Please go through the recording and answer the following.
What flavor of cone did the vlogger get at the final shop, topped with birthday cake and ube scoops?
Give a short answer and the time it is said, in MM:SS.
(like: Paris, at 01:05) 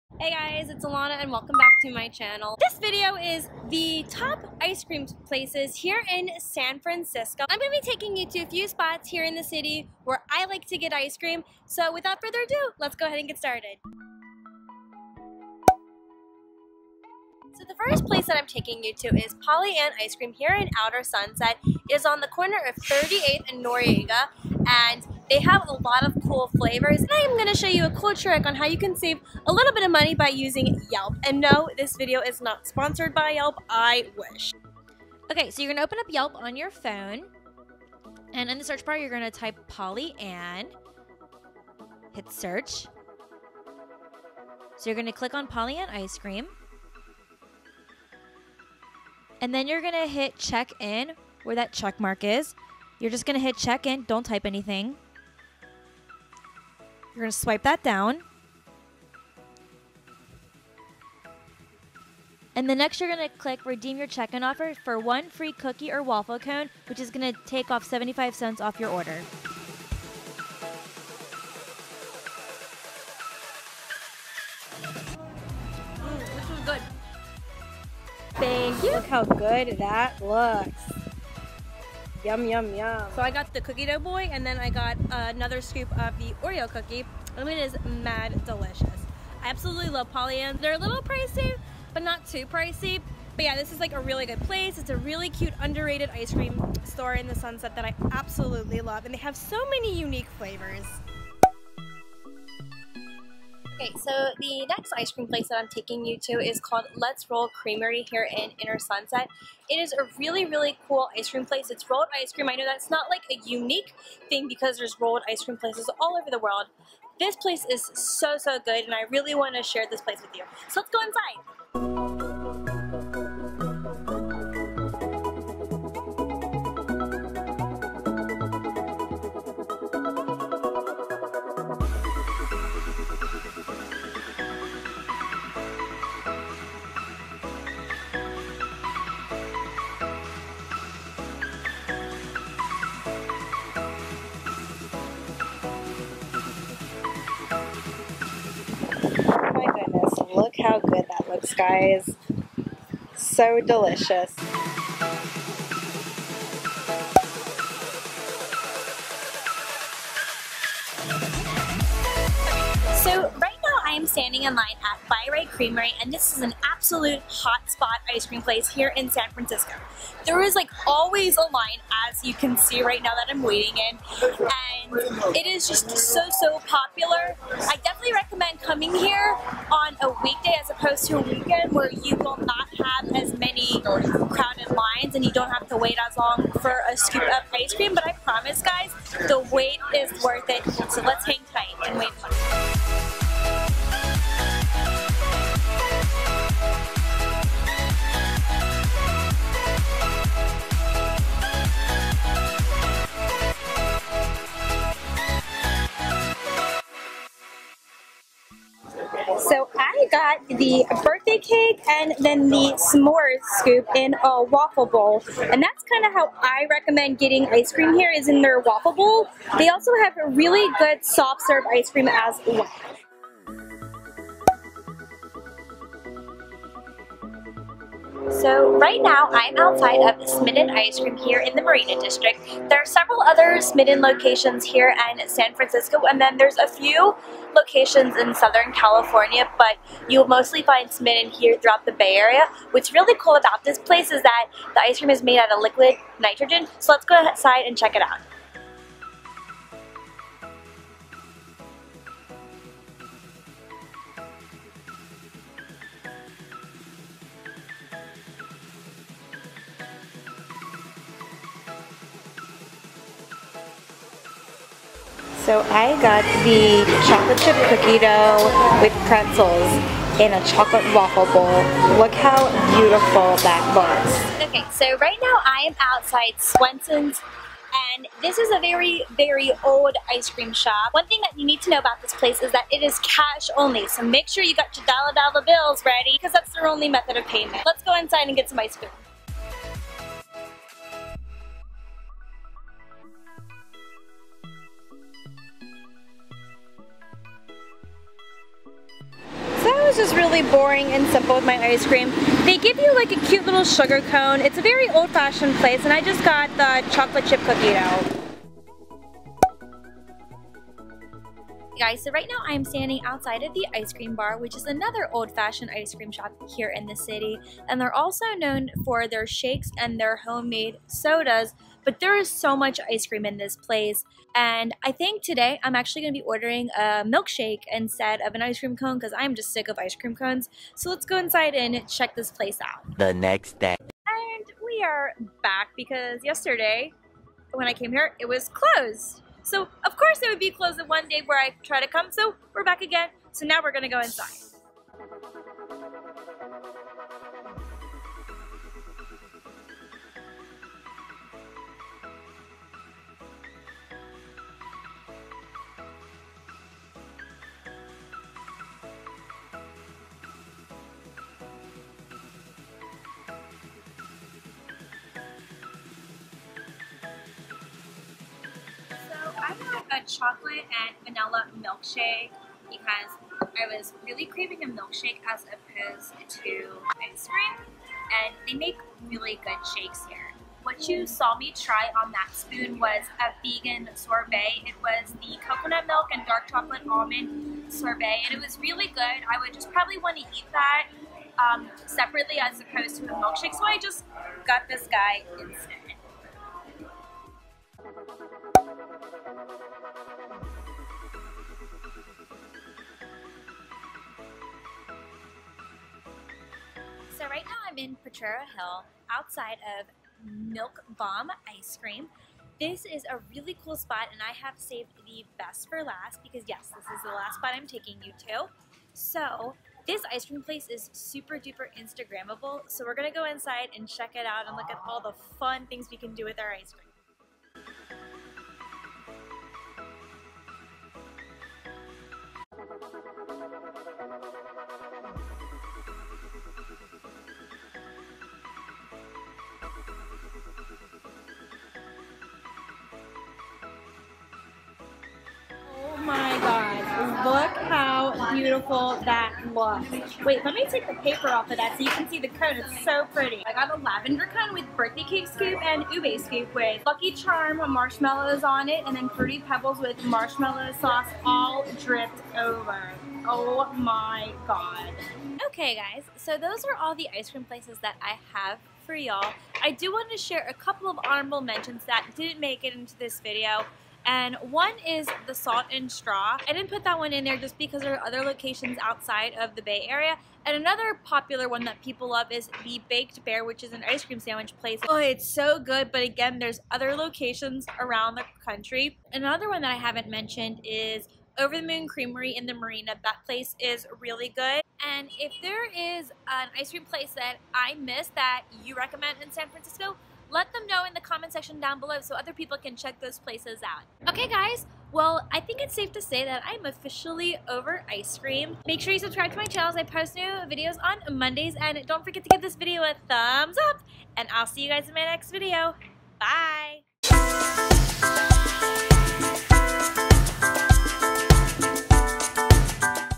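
lavender, at 07:33.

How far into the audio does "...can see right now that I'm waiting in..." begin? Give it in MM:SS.
02:52.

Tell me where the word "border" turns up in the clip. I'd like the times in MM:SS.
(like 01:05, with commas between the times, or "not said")
not said.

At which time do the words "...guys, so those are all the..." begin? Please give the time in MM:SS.
07:45.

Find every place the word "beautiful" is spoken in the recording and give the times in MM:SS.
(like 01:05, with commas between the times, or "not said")
04:32, 07:28.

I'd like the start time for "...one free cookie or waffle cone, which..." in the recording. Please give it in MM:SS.
01:04.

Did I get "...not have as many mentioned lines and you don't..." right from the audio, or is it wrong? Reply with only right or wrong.
wrong.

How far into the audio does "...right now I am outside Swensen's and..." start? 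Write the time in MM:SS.
04:34.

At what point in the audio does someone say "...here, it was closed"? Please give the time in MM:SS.
05:37.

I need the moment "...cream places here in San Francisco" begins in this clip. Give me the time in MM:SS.
00:04.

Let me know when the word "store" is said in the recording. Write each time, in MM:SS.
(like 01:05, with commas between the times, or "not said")
01:36.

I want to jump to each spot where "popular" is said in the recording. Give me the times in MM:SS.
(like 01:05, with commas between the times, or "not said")
02:56, 08:01.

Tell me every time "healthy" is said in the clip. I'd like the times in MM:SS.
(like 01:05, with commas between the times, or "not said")
not said.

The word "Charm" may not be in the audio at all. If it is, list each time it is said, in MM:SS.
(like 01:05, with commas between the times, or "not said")
07:37.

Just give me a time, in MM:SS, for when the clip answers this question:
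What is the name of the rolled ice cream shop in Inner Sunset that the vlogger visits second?
01:46.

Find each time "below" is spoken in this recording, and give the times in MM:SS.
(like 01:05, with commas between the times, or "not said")
08:21.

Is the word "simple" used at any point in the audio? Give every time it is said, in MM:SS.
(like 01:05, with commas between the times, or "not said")
05:01.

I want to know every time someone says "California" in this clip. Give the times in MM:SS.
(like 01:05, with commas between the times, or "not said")
03:58.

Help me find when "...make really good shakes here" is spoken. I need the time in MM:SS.
06:18.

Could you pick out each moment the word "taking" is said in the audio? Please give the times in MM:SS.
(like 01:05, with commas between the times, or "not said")
00:07, 00:18, 01:45, 06:57.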